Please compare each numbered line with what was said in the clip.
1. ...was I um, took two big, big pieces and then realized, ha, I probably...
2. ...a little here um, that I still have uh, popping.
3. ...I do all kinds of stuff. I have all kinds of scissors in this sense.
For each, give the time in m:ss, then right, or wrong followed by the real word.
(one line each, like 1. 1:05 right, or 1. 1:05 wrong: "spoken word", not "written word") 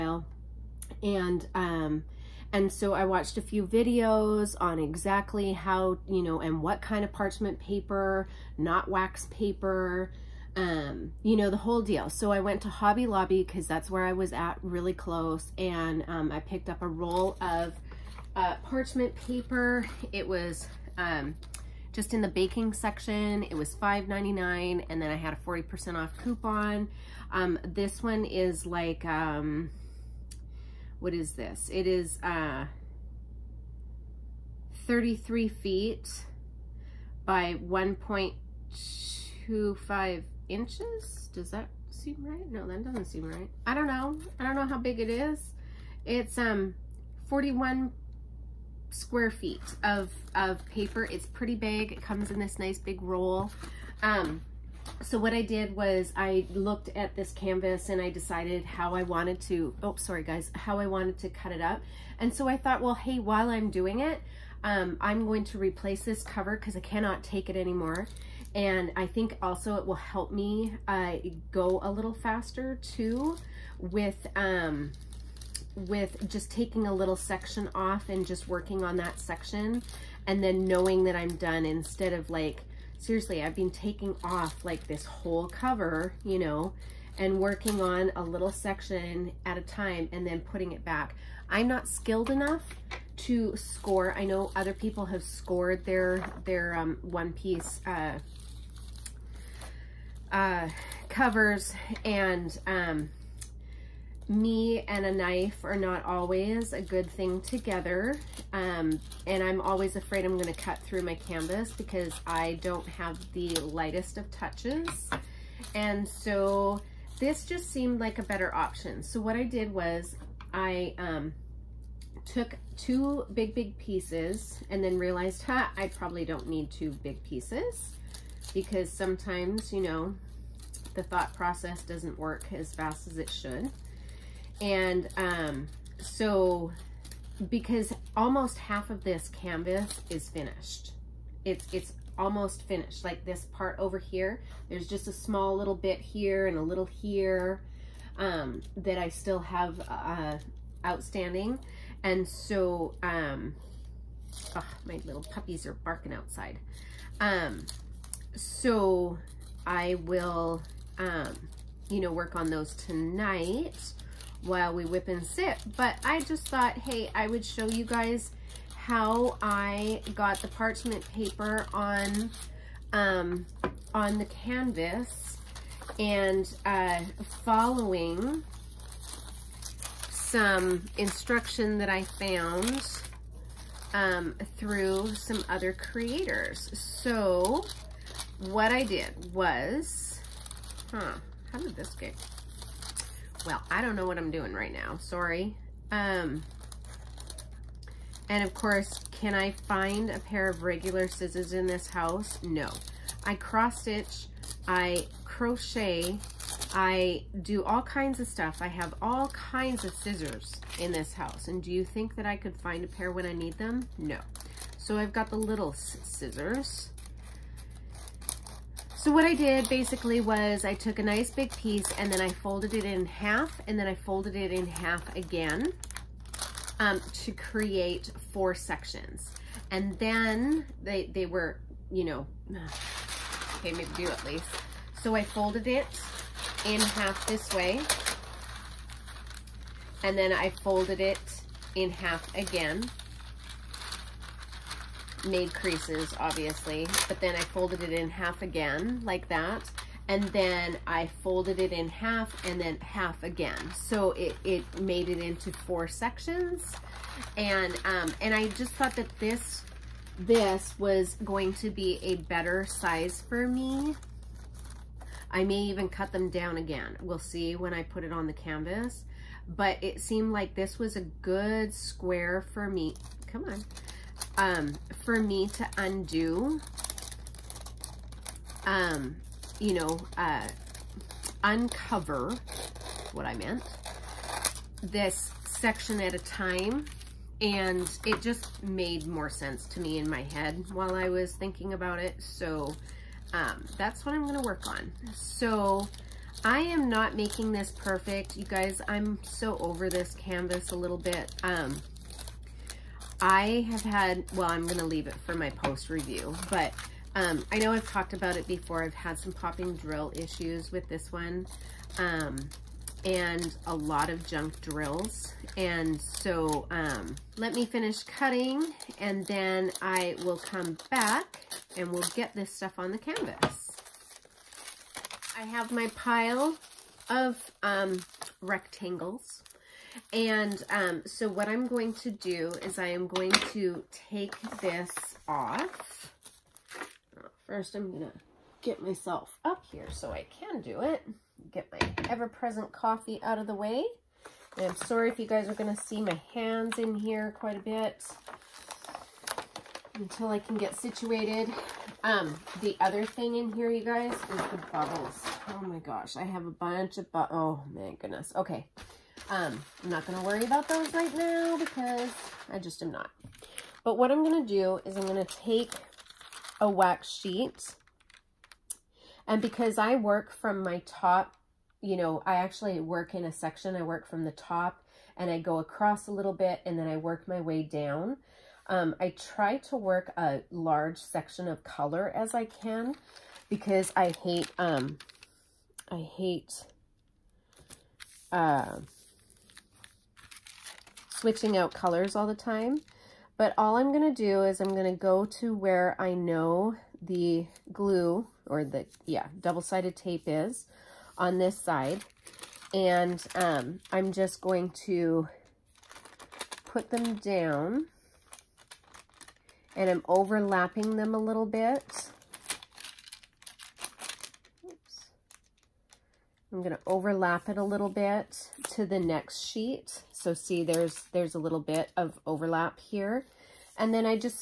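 1. 1:59 right
2. 2:26 wrong: "outstanding", not "popping"
3. 3:26 wrong: "house", not "sense".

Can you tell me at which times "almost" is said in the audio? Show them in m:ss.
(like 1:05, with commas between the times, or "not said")
2:18, 2:22.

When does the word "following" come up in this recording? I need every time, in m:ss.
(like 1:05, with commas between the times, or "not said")
2:57.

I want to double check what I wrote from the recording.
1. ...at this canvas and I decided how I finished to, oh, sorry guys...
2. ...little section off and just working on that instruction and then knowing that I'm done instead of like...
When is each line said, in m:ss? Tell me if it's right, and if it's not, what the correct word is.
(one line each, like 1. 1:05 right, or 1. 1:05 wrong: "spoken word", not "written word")
1. 0:56 wrong: "wanted", not "finished"
2. 1:16 wrong: "section", not "instruction".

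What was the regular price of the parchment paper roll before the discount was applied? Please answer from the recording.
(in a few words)
$5.99.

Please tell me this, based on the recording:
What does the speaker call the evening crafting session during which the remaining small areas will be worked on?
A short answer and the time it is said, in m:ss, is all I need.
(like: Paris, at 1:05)
whip and sip, at 2:44.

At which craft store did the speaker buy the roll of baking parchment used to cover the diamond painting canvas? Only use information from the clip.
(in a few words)
Hobby Lobby.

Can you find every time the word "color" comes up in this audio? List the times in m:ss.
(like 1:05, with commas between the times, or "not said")
6:21, 6:31.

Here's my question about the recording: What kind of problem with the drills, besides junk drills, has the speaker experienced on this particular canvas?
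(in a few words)
popping drill issues.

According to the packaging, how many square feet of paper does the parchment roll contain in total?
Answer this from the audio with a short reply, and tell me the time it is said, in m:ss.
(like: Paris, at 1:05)
41 square feet, at 0:47.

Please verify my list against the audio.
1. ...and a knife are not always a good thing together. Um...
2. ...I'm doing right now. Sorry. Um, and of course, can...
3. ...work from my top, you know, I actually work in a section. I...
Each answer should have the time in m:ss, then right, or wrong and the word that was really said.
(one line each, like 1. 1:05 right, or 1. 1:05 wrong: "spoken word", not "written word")
1. 1:44 right
2. 3:14 right
3. 6:09 right.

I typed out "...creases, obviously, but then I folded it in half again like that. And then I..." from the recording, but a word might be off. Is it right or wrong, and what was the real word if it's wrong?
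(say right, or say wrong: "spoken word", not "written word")
right.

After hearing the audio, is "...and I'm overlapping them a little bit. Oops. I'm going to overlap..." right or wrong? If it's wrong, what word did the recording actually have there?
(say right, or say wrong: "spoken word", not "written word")
right.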